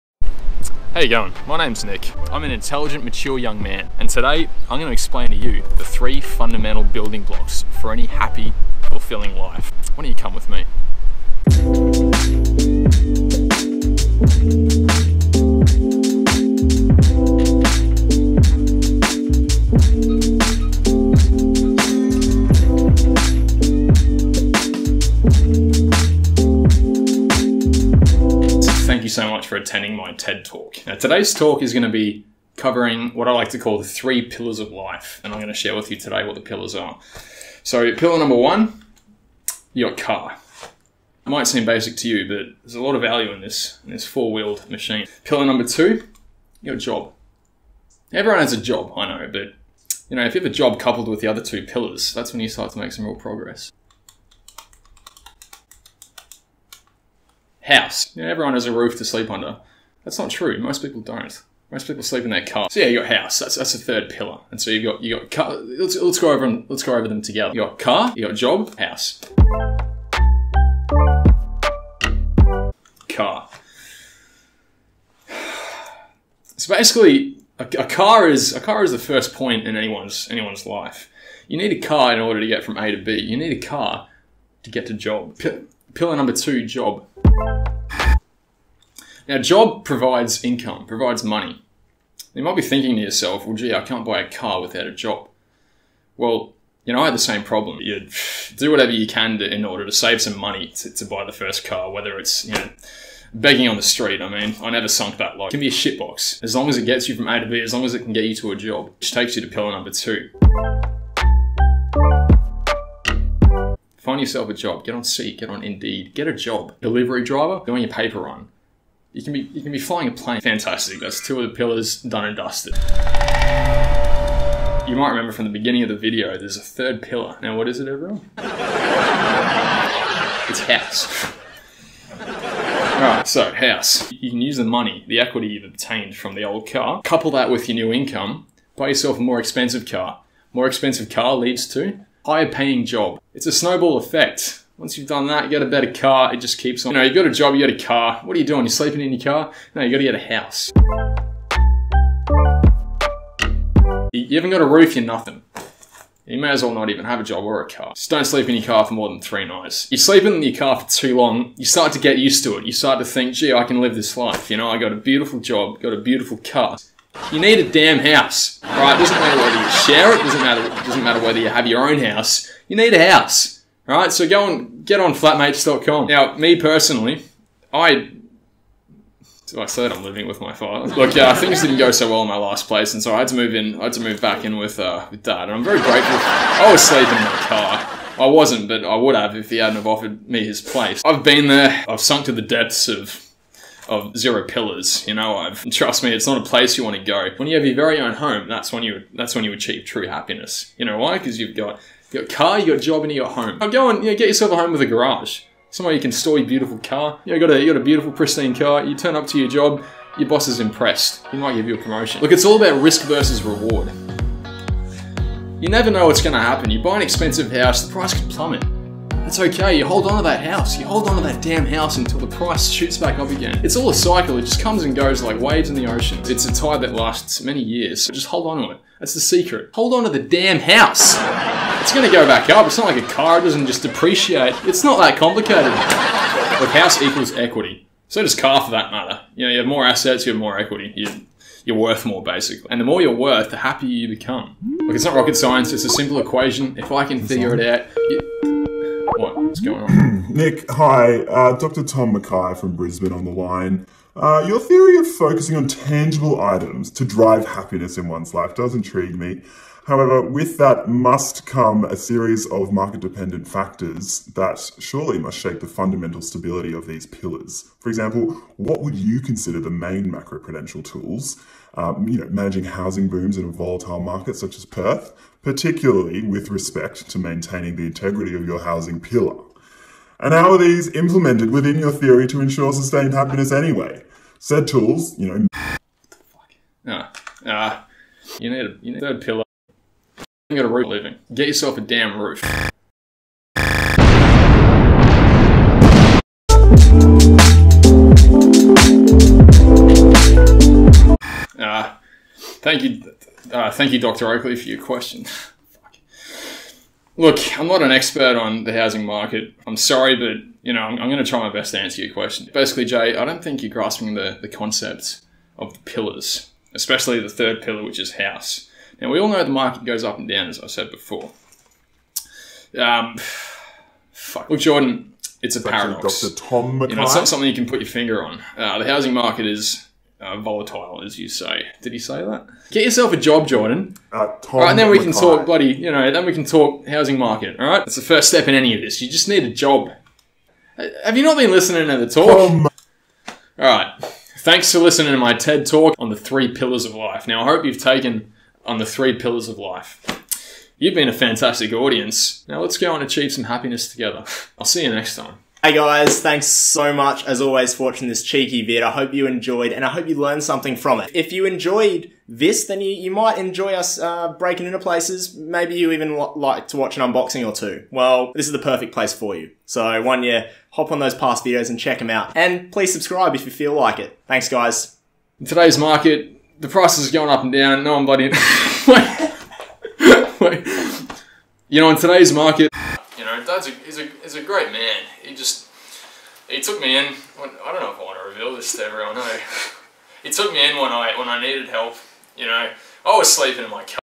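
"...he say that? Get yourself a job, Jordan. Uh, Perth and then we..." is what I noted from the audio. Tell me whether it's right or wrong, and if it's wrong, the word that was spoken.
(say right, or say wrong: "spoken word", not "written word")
wrong: "Tom", not "Perth".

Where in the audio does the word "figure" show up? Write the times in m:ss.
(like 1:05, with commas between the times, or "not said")
4:07.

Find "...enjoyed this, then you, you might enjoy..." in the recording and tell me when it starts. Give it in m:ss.
6:01.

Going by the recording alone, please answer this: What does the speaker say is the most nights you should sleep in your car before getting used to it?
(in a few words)
3.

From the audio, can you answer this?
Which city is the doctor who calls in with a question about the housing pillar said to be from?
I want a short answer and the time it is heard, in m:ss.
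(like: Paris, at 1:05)
Brisbane, at 4:12.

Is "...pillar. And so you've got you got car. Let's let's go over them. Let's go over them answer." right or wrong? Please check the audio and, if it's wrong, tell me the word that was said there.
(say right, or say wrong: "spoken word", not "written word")
wrong: "together", not "answer".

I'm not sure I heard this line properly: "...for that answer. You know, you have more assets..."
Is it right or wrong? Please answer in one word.
wrong.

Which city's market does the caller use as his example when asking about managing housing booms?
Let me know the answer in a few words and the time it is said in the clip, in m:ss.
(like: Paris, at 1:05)
Perth, at 4:34.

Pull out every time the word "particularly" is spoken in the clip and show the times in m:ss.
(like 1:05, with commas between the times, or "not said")
4:35.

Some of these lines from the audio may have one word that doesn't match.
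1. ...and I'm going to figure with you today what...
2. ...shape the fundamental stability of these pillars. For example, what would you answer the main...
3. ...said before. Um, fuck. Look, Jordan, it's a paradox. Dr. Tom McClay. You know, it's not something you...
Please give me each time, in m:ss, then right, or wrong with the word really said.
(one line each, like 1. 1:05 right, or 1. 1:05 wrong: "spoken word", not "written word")
1. 0:35 wrong: "share", not "figure"
2. 4:25 wrong: "consider", not "answer"
3. 5:20 right.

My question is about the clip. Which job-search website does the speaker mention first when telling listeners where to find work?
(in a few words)
Seek.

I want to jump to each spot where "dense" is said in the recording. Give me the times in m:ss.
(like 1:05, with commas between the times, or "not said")
not said.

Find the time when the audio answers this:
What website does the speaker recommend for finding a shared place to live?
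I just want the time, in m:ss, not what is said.
2:55.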